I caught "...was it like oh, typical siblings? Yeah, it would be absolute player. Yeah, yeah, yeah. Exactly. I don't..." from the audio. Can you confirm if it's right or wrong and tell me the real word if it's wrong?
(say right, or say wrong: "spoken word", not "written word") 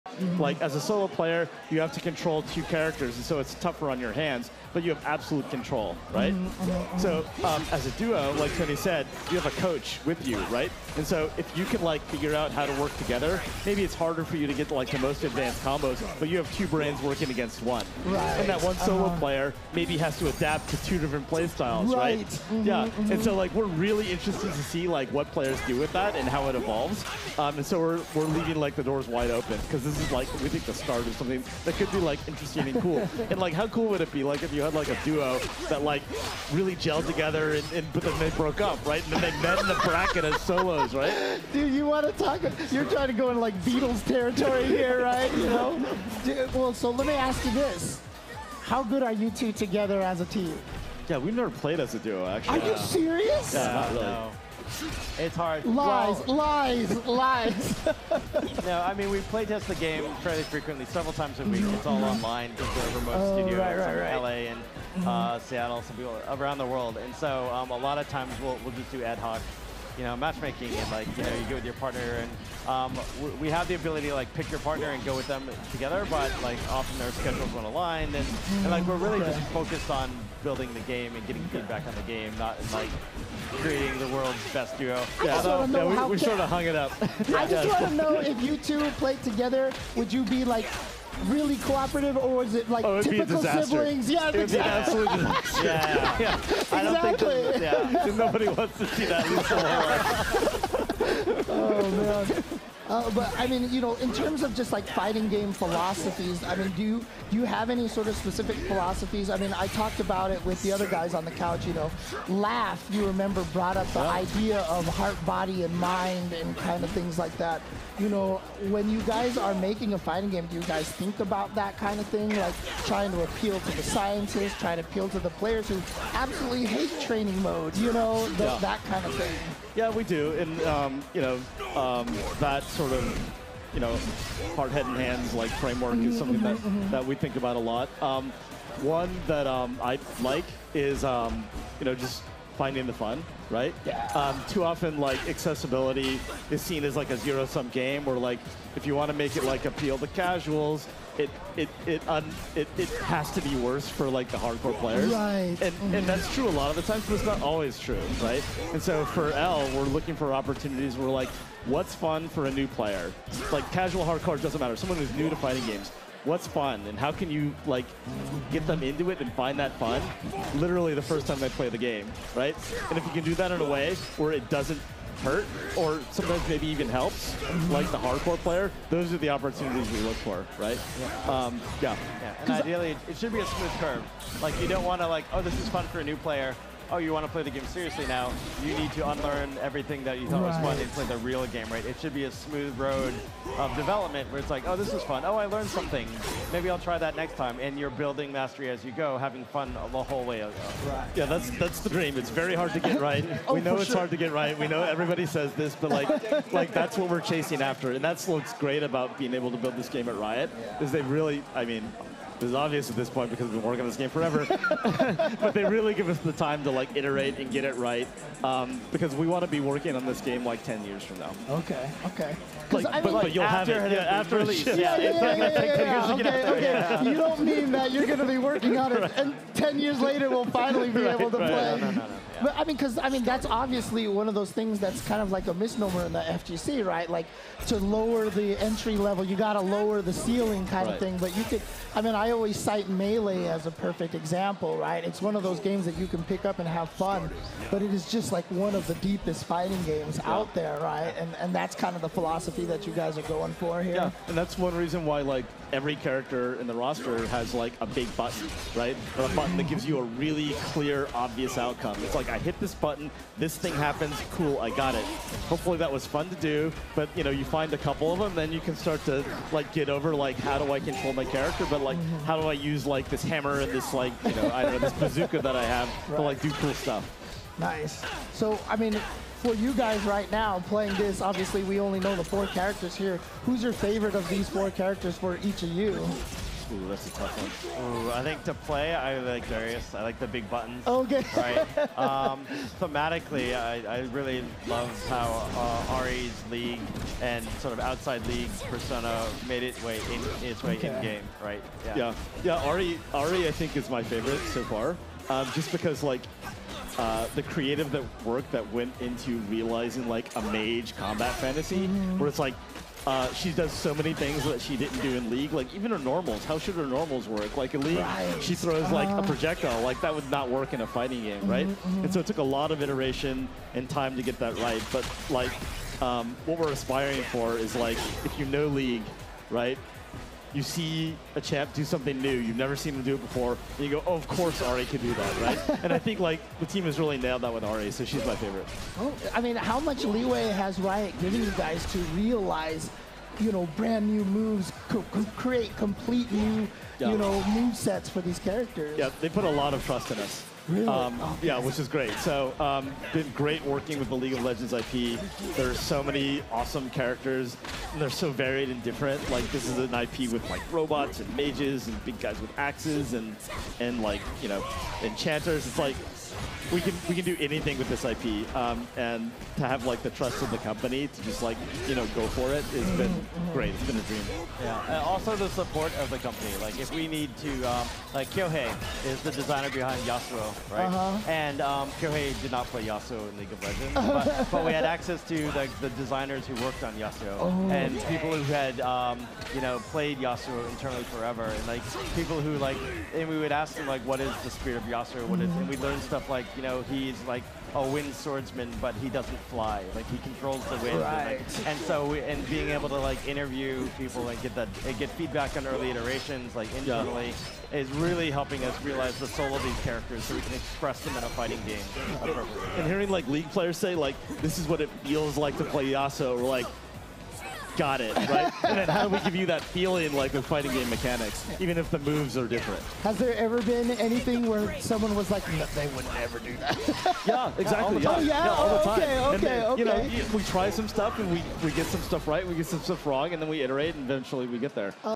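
wrong: "disaster", not "player".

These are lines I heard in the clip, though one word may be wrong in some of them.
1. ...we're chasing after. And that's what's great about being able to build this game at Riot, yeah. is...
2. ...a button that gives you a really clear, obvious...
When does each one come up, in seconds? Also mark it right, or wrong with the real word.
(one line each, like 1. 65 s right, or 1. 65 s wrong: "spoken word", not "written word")
1. 207 s right
2. 259 s right.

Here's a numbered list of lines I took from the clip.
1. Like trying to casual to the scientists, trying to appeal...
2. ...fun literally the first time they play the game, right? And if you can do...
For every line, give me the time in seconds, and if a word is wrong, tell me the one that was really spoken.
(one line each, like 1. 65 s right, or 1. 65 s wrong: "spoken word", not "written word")
1. 122 s wrong: "appeal", not "casual"
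2. 169 s right.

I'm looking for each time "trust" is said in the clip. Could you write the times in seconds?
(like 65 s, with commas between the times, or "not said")
349 s, 370 s.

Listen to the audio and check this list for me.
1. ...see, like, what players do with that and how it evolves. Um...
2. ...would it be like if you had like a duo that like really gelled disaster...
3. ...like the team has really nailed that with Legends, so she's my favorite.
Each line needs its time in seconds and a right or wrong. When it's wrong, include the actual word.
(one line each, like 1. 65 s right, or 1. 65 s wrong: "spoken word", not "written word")
1. 24 s right
2. 33 s wrong: "together", not "disaster"
3. 336 s wrong: "Ahri", not "Legends".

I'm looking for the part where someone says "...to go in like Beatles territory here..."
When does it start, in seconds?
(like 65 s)
43 s.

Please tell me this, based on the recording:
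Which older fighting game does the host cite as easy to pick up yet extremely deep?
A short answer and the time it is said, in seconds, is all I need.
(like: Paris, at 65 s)
Melee, at 242 s.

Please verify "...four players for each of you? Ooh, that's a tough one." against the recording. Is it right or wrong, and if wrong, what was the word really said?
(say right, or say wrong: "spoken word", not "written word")
wrong: "characters", not "players".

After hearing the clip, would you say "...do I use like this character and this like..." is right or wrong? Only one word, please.
wrong.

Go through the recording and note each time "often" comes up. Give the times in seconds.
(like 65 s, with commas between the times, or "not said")
76 s, 144 s.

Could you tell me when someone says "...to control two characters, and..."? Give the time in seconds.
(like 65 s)
1 s.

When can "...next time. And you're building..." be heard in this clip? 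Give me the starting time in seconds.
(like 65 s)
197 s.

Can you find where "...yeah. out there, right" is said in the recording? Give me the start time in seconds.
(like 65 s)
250 s.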